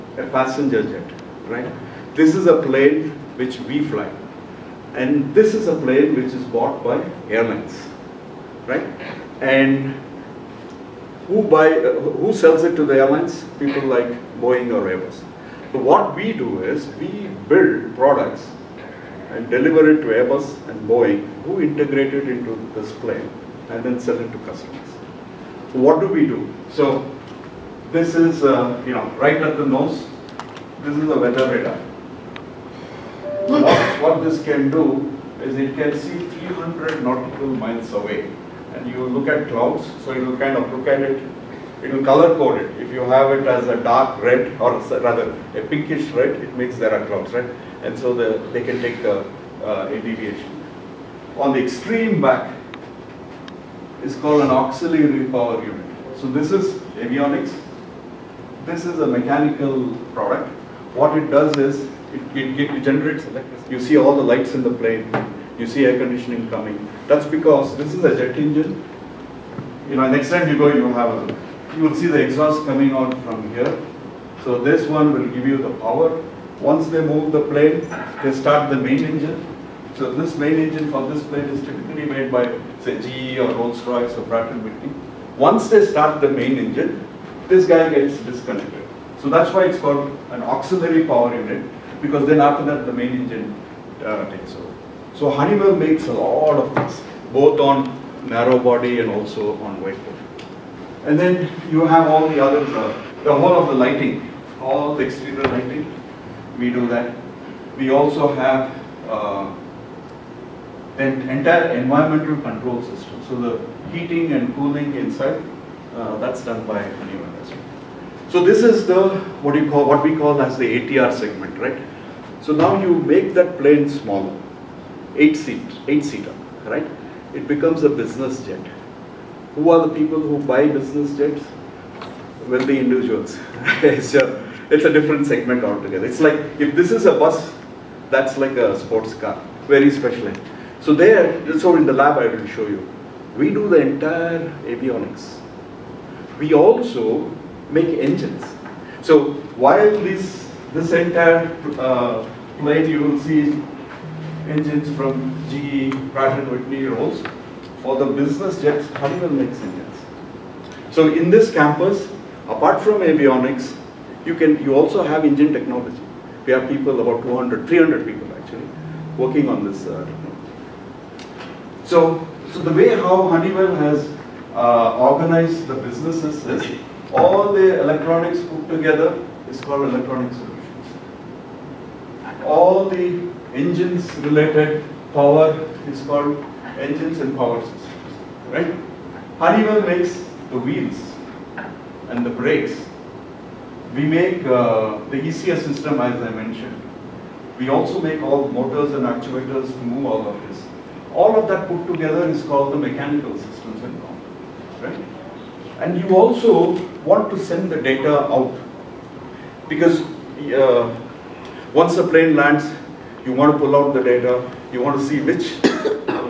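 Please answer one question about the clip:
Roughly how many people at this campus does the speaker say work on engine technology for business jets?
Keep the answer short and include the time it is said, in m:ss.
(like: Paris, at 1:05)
200 to 300, at 2:47.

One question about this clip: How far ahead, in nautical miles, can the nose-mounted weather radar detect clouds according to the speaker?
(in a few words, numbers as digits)
300 nautical miles.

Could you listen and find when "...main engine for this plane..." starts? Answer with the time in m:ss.
1:20.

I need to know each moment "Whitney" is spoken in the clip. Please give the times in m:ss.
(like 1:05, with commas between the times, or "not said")
1:24, 2:36.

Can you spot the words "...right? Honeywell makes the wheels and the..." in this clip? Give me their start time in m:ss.
3:08.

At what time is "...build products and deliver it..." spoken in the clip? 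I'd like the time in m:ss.
0:17.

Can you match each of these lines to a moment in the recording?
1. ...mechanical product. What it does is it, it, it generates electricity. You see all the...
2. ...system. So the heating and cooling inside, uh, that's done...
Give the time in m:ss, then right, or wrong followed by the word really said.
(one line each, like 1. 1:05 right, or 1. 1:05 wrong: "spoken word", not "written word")
1. 0:59 right
2. 1:52 right.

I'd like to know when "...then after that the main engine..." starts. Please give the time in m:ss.
1:32.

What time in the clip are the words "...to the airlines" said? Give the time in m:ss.
0:12.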